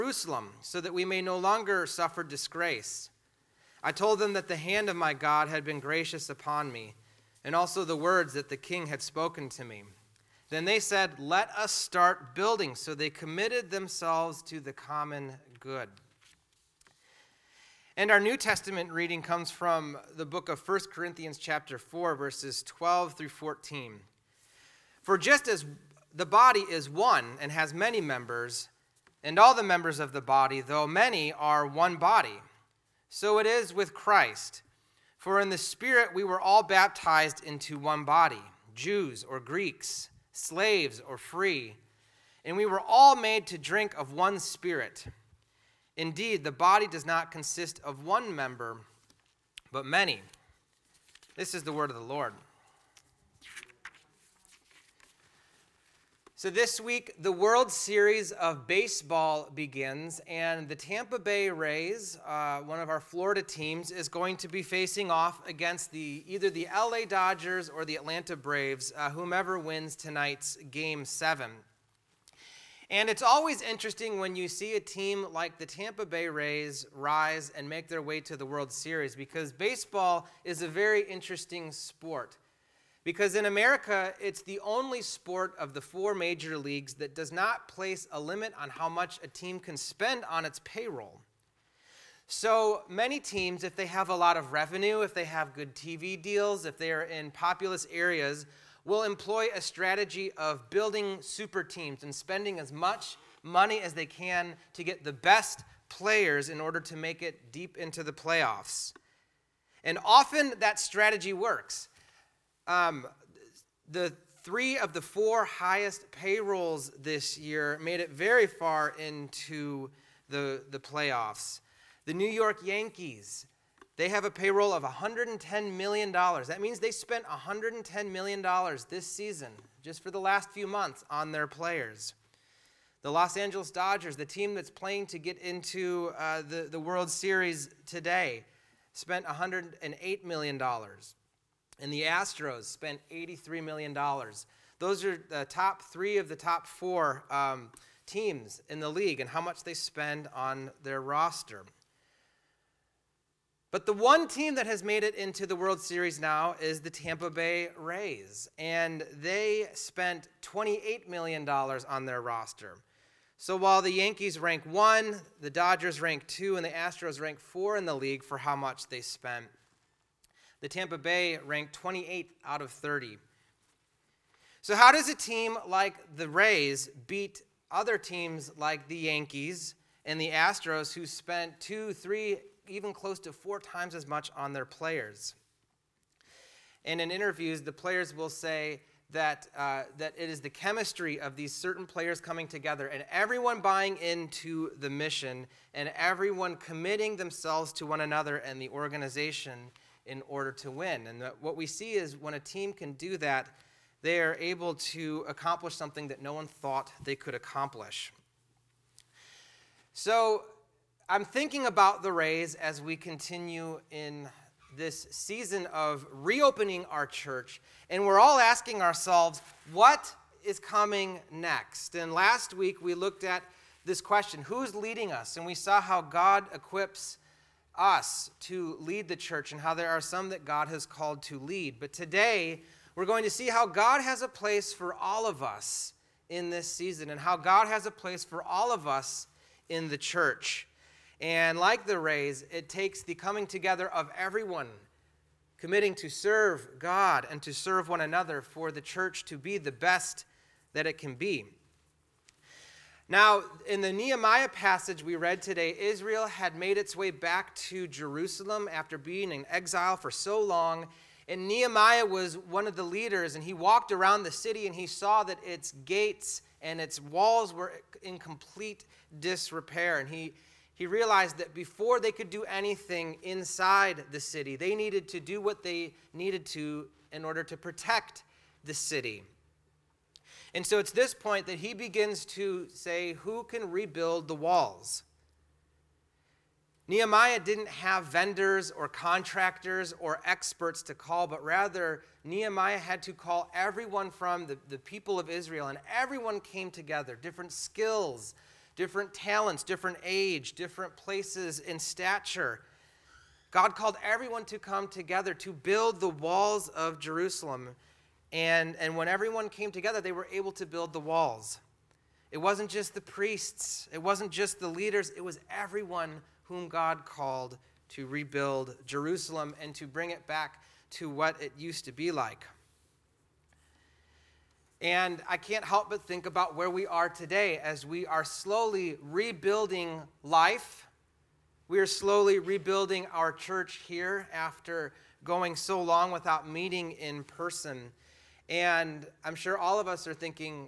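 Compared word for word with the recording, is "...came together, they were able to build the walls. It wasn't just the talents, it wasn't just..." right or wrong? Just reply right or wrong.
wrong.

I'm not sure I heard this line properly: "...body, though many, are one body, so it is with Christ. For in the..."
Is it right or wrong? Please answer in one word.
right.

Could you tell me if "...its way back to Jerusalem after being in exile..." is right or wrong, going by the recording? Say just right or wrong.
right.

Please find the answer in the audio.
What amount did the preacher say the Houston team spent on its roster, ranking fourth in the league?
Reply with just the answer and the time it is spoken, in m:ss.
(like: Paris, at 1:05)
$83 million, at 2:23.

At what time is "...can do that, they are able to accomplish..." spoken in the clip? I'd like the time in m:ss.
3:22.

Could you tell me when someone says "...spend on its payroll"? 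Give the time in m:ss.
1:29.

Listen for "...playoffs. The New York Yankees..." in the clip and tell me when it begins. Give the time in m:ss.
2:00.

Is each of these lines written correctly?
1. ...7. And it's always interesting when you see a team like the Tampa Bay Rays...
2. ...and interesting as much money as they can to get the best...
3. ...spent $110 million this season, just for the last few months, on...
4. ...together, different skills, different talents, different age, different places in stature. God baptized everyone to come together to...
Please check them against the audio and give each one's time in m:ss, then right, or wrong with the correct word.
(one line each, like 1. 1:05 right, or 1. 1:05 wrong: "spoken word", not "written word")
1. 1:11 right
2. 1:42 wrong: "spending", not "interesting"
3. 2:06 right
4. 4:56 wrong: "called", not "baptized".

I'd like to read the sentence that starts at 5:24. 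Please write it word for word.
And I can't help but think about where we are today as we are slowly rebuilding life.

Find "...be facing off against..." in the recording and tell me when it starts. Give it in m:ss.
1:04.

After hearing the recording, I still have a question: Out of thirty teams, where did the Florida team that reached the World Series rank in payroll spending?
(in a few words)
28th.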